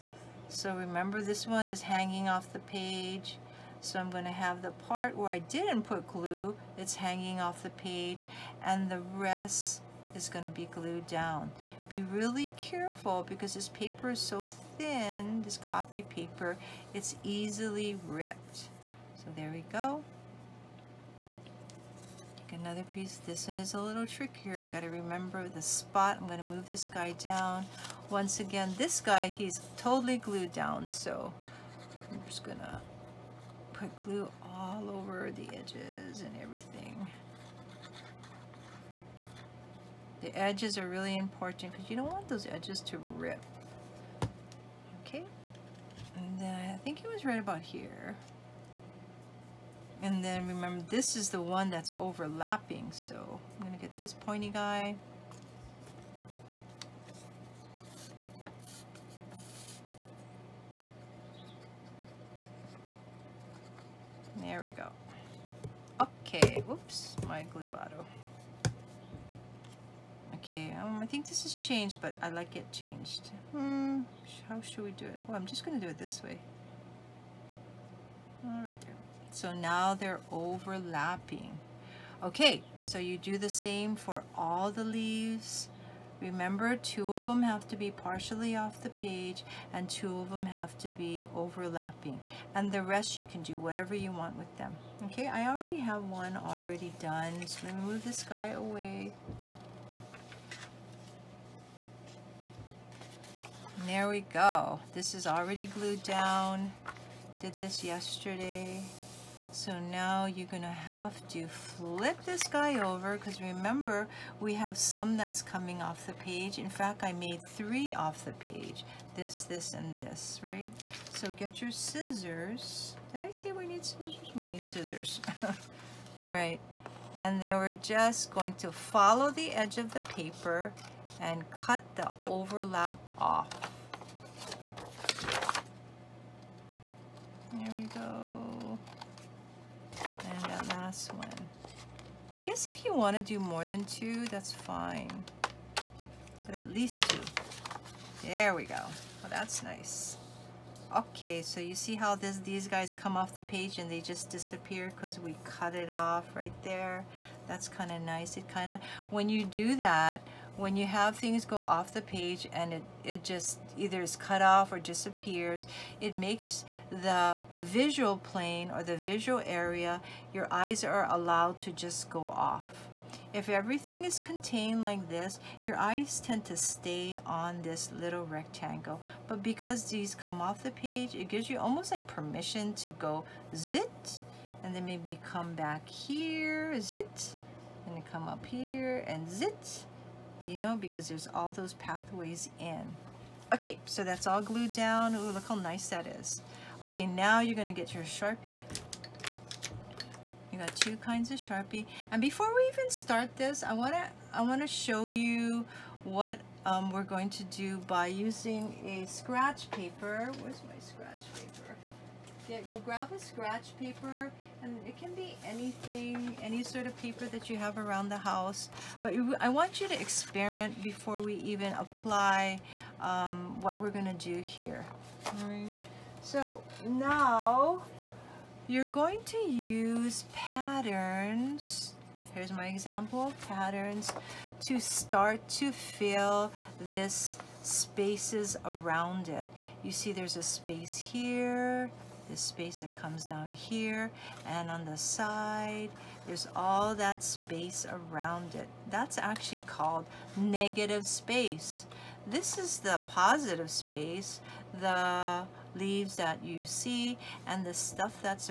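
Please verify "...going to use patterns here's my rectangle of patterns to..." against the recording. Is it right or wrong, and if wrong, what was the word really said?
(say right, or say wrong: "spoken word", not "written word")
wrong: "example", not "rectangle".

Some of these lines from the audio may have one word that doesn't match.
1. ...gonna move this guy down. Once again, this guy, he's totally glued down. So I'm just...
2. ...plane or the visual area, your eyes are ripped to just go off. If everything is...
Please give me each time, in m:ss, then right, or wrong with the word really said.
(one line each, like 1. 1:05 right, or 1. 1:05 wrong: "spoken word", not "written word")
1. 0:26 right
2. 2:48 wrong: "allowed", not "ripped".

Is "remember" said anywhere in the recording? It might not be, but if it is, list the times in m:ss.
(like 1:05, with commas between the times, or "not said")
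0:00, 0:24, 0:50, 1:26, 1:53.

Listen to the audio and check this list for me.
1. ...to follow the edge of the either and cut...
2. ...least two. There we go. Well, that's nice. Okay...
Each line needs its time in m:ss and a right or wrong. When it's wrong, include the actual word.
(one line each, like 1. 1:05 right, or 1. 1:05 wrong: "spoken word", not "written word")
1. 2:08 wrong: "paper", not "either"
2. 2:26 right.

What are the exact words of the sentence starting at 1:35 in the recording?
Okay, I already have one already done.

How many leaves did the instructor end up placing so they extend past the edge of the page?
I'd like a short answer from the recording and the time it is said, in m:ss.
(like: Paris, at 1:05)
3, at 1:57.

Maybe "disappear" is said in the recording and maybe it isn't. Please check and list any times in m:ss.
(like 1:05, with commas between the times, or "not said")
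2:34, 2:44.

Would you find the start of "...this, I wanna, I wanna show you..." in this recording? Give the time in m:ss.
3:23.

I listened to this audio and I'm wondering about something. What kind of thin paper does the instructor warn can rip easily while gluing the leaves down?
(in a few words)
copy paper.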